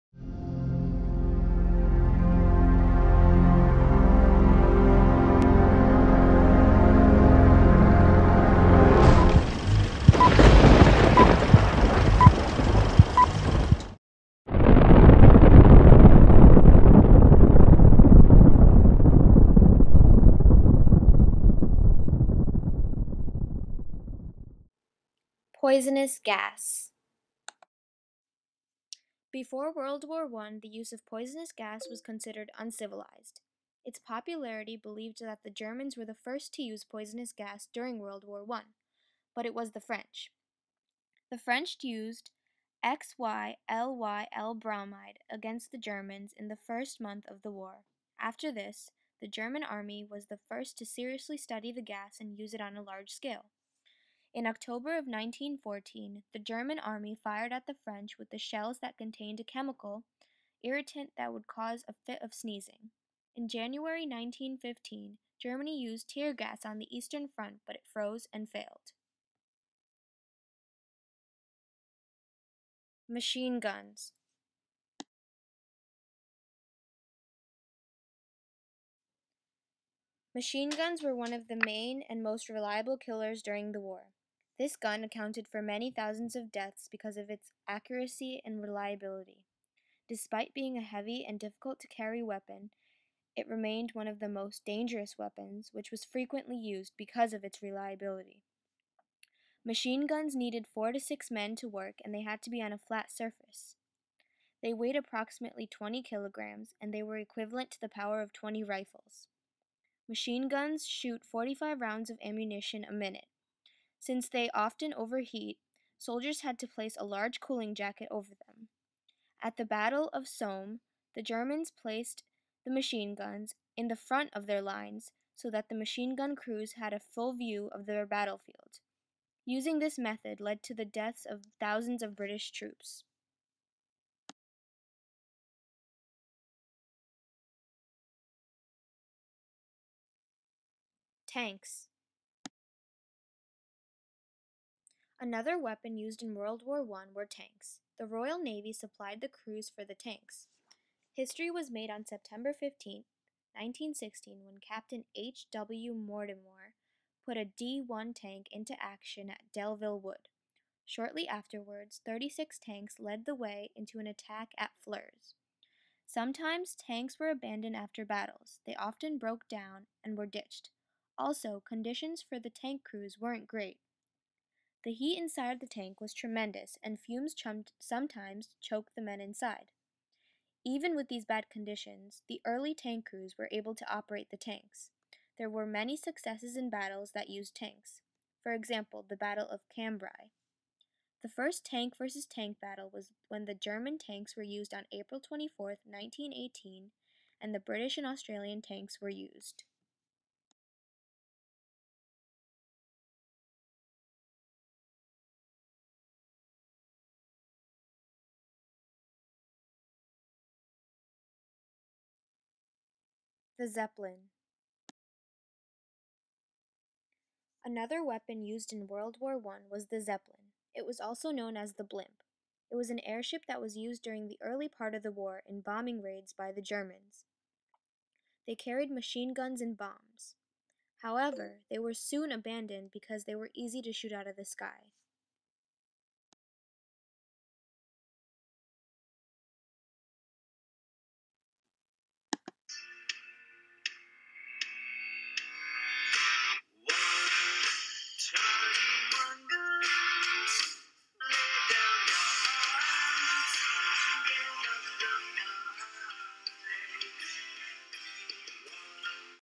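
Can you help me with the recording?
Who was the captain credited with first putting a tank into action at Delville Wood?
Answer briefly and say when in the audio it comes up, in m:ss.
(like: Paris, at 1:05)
H. W. Mortimer, at 2:35.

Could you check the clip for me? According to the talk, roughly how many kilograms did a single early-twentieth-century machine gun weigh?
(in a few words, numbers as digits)
20 kilograms.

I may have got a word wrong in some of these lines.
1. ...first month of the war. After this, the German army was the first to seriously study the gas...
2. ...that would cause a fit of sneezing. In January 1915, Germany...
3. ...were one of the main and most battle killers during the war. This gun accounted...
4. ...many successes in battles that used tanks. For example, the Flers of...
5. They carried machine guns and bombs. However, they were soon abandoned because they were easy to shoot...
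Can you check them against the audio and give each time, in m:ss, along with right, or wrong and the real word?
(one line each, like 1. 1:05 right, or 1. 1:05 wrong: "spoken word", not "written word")
1. 0:46 right
2. 1:01 right
3. 1:21 wrong: "reliable", not "battle"
4. 3:05 wrong: "Battle", not "Flers"
5. 3:48 right.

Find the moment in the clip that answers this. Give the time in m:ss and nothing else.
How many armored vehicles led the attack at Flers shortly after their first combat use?
2:42.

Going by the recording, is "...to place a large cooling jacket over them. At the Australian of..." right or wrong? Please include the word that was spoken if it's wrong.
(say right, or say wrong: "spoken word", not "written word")
wrong: "Battle", not "Australian".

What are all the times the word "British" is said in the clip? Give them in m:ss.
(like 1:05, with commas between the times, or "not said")
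2:12, 3:17.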